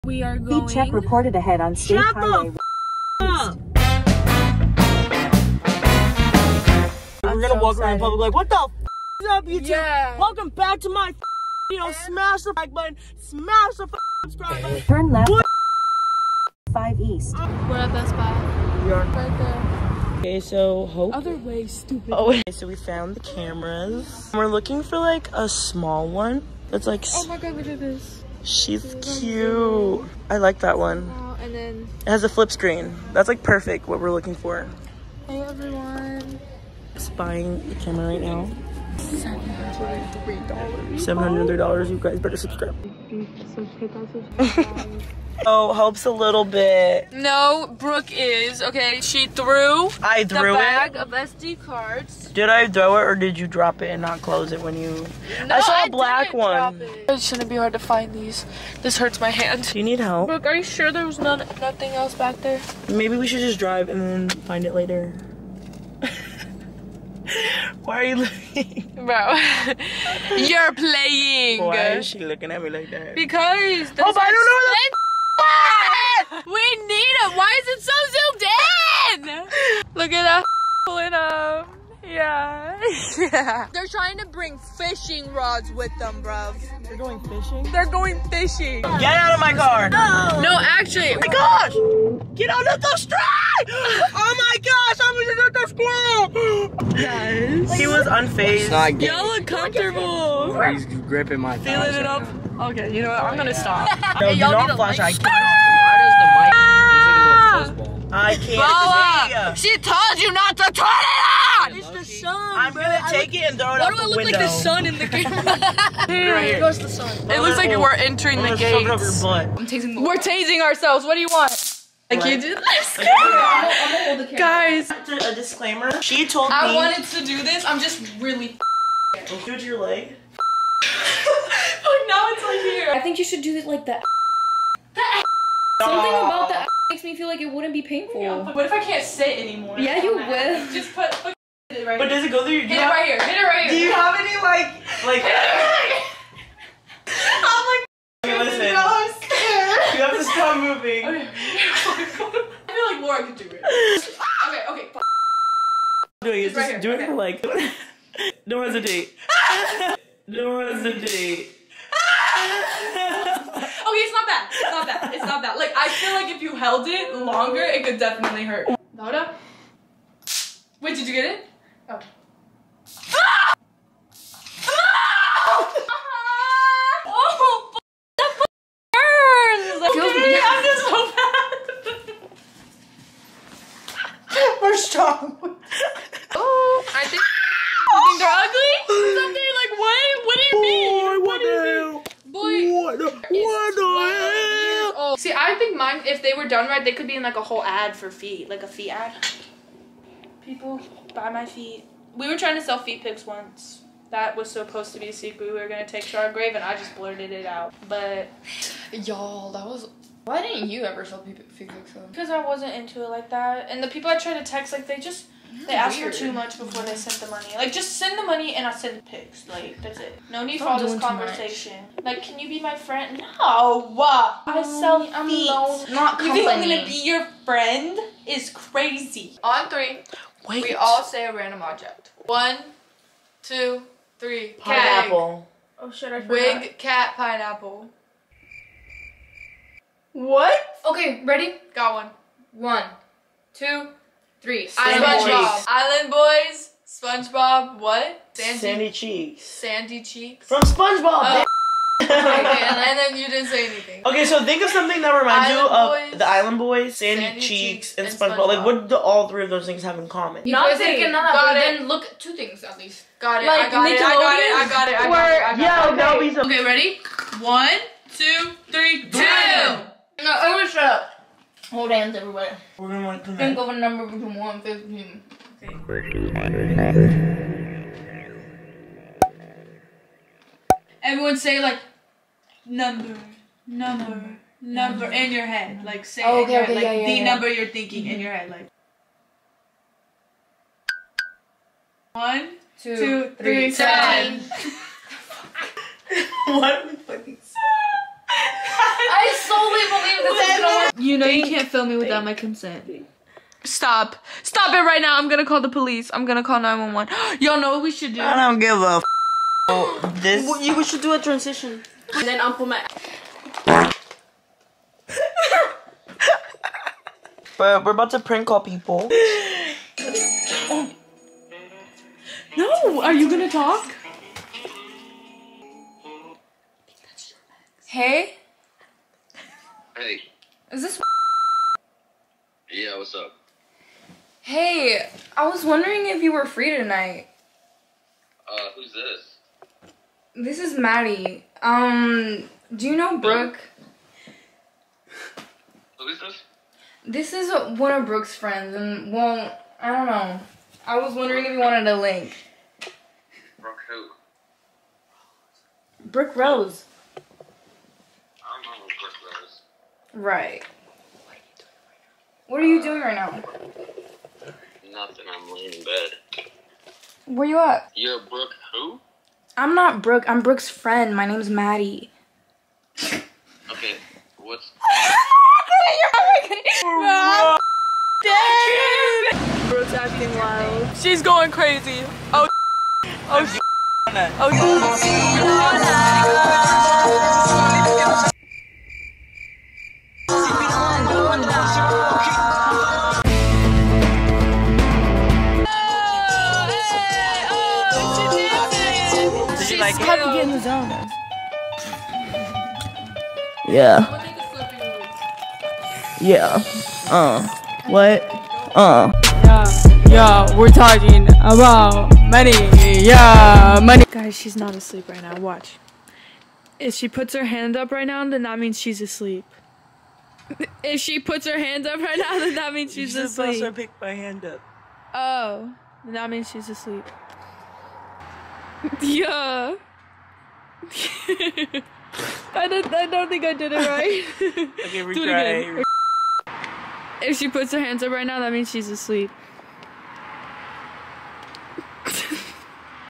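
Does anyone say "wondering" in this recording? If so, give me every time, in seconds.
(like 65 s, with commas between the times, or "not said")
335 s, 351 s.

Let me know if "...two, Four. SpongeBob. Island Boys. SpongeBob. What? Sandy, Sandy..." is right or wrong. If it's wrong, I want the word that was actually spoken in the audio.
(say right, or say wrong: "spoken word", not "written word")
wrong: "Three", not "Four".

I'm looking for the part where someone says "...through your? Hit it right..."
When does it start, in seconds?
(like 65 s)
142 s.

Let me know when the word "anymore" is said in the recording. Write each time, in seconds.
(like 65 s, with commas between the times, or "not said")
139 s.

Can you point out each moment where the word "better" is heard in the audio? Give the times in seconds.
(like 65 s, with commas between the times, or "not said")
42 s.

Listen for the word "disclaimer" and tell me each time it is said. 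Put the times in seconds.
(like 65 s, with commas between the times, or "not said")
125 s.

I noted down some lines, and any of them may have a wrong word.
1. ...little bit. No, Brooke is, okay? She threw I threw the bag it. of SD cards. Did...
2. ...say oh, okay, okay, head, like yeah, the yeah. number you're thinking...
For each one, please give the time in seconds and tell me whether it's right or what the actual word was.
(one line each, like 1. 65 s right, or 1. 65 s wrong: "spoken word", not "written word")
1. 46 s right
2. 286 s right.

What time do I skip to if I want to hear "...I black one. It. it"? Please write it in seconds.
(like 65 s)
55 s.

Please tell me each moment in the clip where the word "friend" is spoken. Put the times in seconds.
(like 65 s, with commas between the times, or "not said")
222 s, 227 s, 348 s, 370 s.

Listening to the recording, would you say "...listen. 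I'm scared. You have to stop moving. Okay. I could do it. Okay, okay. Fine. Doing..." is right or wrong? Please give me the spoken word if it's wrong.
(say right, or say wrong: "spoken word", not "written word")
right.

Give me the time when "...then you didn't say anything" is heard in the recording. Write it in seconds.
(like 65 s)
252 s.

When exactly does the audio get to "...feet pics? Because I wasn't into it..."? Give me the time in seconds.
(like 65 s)
211 s.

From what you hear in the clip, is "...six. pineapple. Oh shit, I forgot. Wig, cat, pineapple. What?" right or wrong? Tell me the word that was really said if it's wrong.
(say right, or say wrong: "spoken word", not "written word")
wrong: "three", not "six".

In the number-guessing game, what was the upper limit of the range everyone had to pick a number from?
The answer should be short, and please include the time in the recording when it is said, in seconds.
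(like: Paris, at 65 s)
15, at 274 s.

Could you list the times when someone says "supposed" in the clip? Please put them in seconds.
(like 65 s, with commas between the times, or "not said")
204 s, 423 s.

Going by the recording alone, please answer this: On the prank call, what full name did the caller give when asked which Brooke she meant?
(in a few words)
Brooke Rose.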